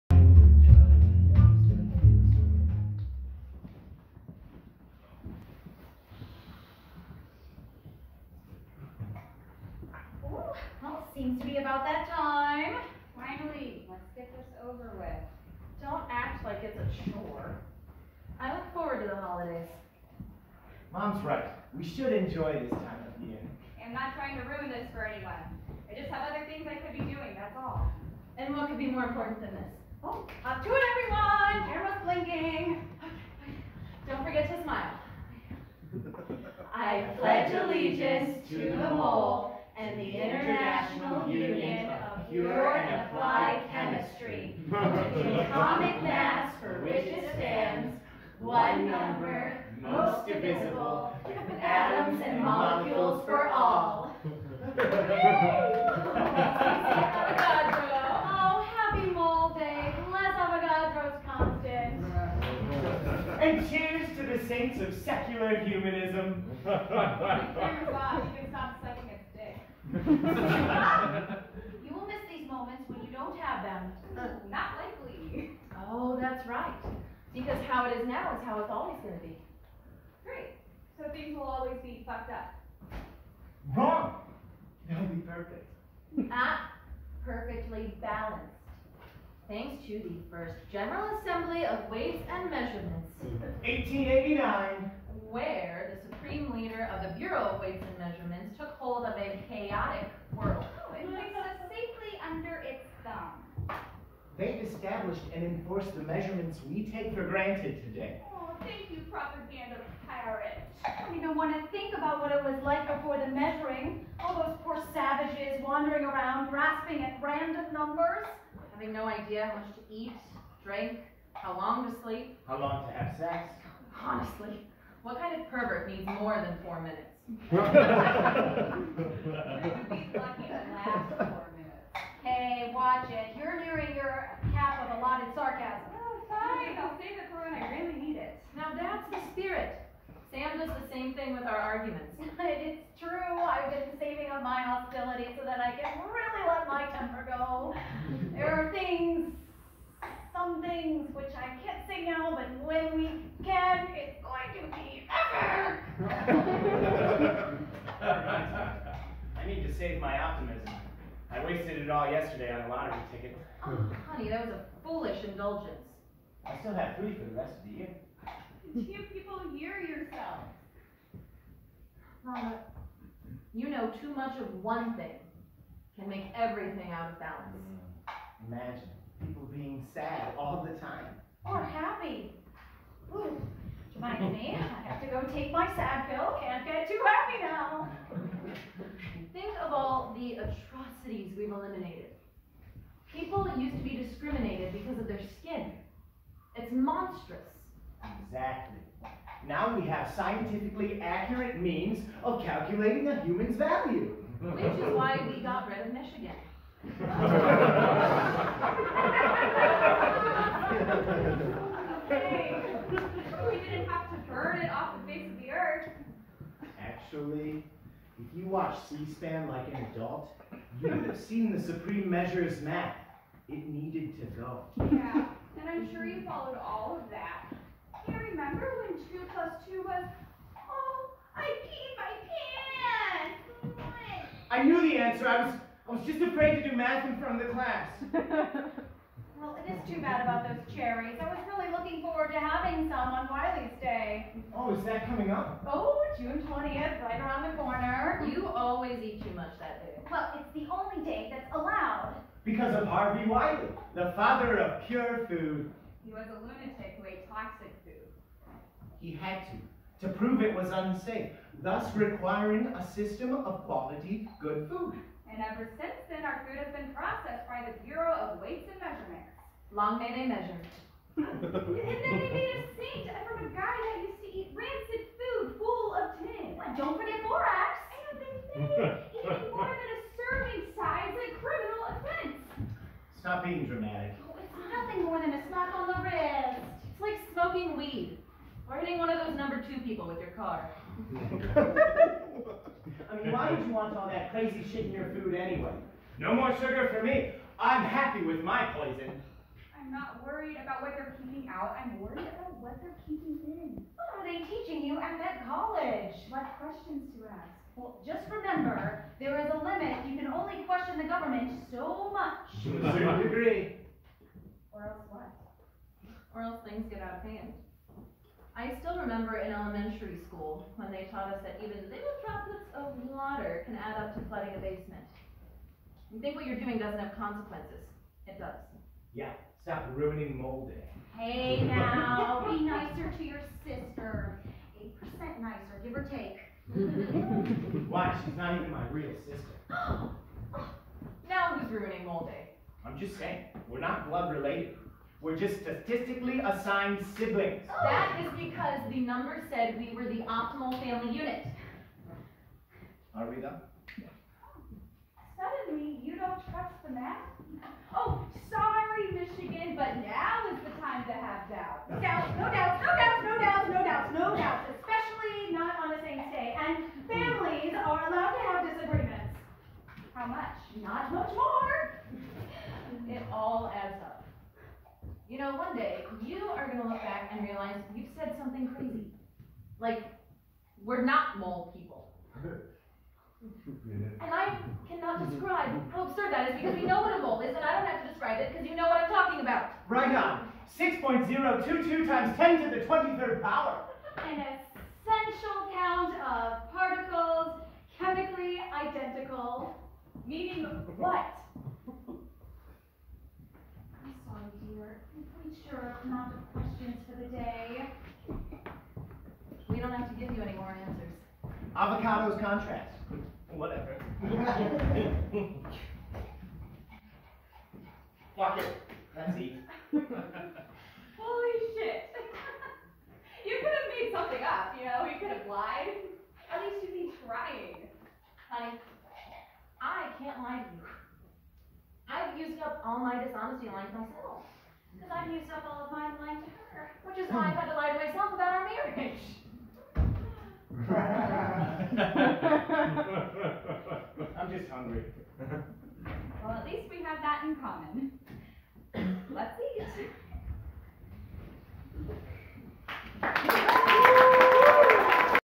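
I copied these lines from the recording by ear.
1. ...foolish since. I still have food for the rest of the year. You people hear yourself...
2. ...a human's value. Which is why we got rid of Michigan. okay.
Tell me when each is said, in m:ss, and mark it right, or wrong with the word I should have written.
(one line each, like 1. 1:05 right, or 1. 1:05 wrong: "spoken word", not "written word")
1. 2:44 wrong: "indulgence", not "since"
2. 3:23 right.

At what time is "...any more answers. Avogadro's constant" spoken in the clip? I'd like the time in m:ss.
6:50.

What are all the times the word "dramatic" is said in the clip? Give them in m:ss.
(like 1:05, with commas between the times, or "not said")
4:43.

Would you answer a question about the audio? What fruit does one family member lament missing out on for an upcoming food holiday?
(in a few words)
Cherries.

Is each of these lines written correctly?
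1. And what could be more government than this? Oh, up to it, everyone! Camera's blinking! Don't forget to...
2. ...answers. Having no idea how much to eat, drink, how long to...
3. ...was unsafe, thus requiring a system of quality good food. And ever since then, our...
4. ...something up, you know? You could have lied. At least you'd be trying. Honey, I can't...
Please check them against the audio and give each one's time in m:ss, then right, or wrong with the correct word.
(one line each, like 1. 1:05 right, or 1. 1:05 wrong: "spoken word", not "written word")
1. 0:28 wrong: "important", not "government"
2. 1:57 wrong: "numbers", not "answers"
3. 4:20 right
4. 7:04 right.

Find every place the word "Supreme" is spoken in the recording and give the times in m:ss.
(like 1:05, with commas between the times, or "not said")
1:36, 3:41.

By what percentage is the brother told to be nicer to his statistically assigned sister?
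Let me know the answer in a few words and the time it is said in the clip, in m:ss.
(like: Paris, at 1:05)
8%, at 5:34.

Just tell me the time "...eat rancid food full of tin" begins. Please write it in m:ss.
4:34.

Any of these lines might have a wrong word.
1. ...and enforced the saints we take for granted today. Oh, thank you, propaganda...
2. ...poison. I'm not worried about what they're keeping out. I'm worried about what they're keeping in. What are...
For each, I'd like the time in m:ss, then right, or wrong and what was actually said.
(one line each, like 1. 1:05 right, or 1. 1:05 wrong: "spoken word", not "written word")
1. 1:45 wrong: "measurements", not "saints"
2. 4:58 right.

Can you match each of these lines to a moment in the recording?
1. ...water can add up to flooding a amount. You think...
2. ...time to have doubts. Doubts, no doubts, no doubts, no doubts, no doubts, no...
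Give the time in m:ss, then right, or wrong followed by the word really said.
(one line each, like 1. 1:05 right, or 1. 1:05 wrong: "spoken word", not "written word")
1. 5:23 wrong: "basement", not "amount"
2. 6:00 right.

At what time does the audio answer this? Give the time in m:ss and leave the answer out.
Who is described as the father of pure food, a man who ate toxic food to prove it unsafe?
4:12.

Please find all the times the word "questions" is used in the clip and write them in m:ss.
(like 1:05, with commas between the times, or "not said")
5:06, 5:10, 6:46.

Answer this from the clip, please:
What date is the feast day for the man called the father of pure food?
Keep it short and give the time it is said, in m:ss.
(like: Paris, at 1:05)
June 20th, at 4:06.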